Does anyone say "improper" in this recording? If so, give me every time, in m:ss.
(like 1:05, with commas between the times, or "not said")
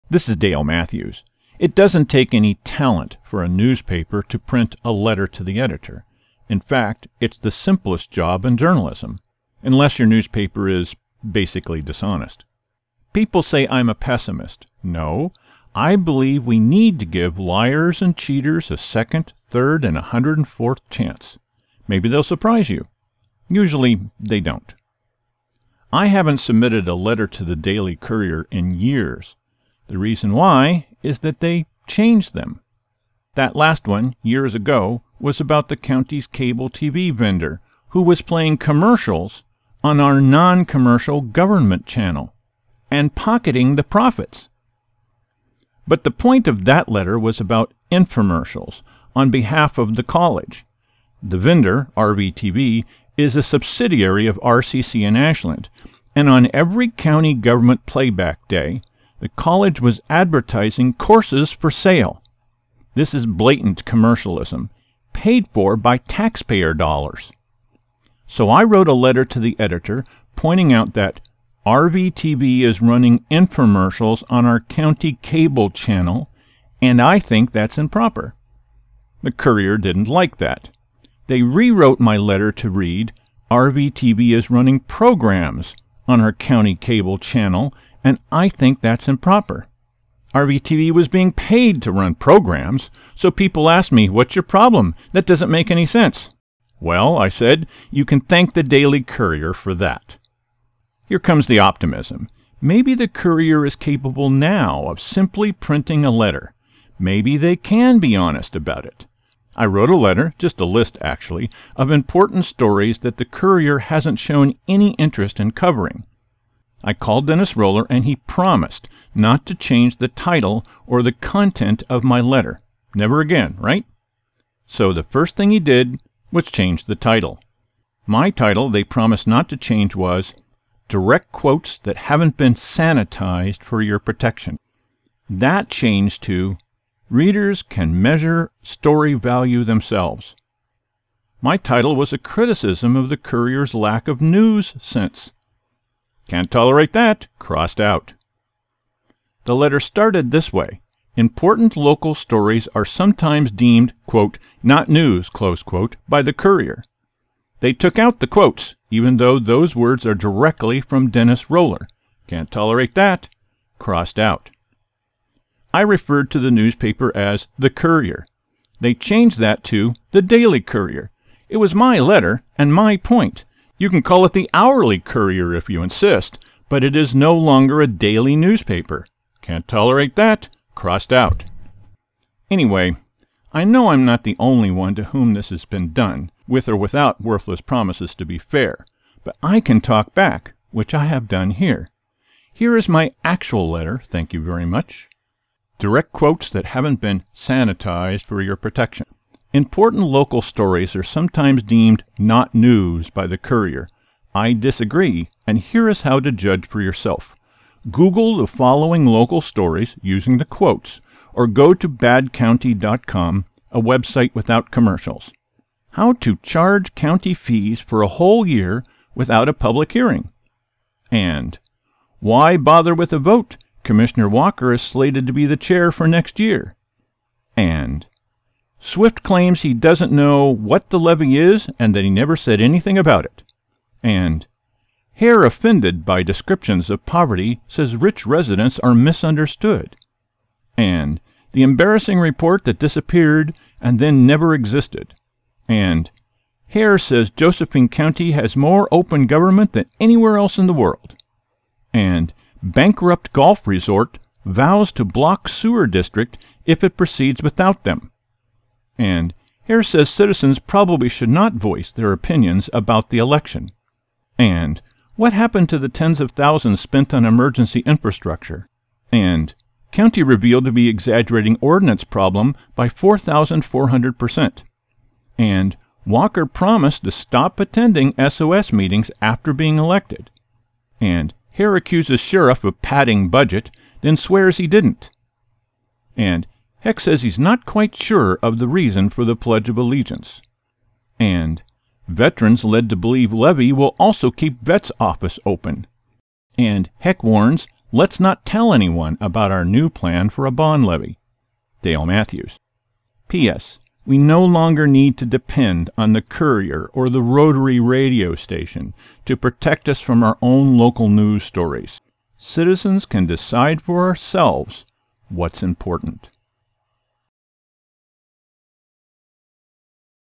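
1:17, 1:29.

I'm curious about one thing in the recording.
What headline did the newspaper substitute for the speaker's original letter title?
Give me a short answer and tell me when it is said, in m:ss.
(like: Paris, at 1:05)
Readers Can Measure Story Value Themselves, at 2:17.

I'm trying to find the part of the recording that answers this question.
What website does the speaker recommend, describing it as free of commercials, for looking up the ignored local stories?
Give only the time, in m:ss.
3:31.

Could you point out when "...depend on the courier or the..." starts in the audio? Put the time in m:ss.
5:05.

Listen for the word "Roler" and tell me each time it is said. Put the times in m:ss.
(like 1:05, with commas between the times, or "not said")
1:57, 2:41.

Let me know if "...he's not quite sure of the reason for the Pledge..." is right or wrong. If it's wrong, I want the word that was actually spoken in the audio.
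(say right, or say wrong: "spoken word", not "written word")
right.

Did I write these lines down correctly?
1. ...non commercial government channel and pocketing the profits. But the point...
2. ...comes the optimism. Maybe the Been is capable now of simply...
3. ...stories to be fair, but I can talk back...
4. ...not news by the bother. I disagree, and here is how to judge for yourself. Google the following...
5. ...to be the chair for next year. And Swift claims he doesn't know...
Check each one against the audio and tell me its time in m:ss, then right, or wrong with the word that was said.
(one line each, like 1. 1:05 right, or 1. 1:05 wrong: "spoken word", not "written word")
1. 0:40 right
2. 1:41 wrong: "Courier", not "Been"
3. 3:07 wrong: "promises", not "stories"
4. 3:22 wrong: "courier", not "bother"
5. 3:45 right.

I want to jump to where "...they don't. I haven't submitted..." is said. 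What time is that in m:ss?
0:24.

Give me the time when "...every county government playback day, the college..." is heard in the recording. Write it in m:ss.
0:56.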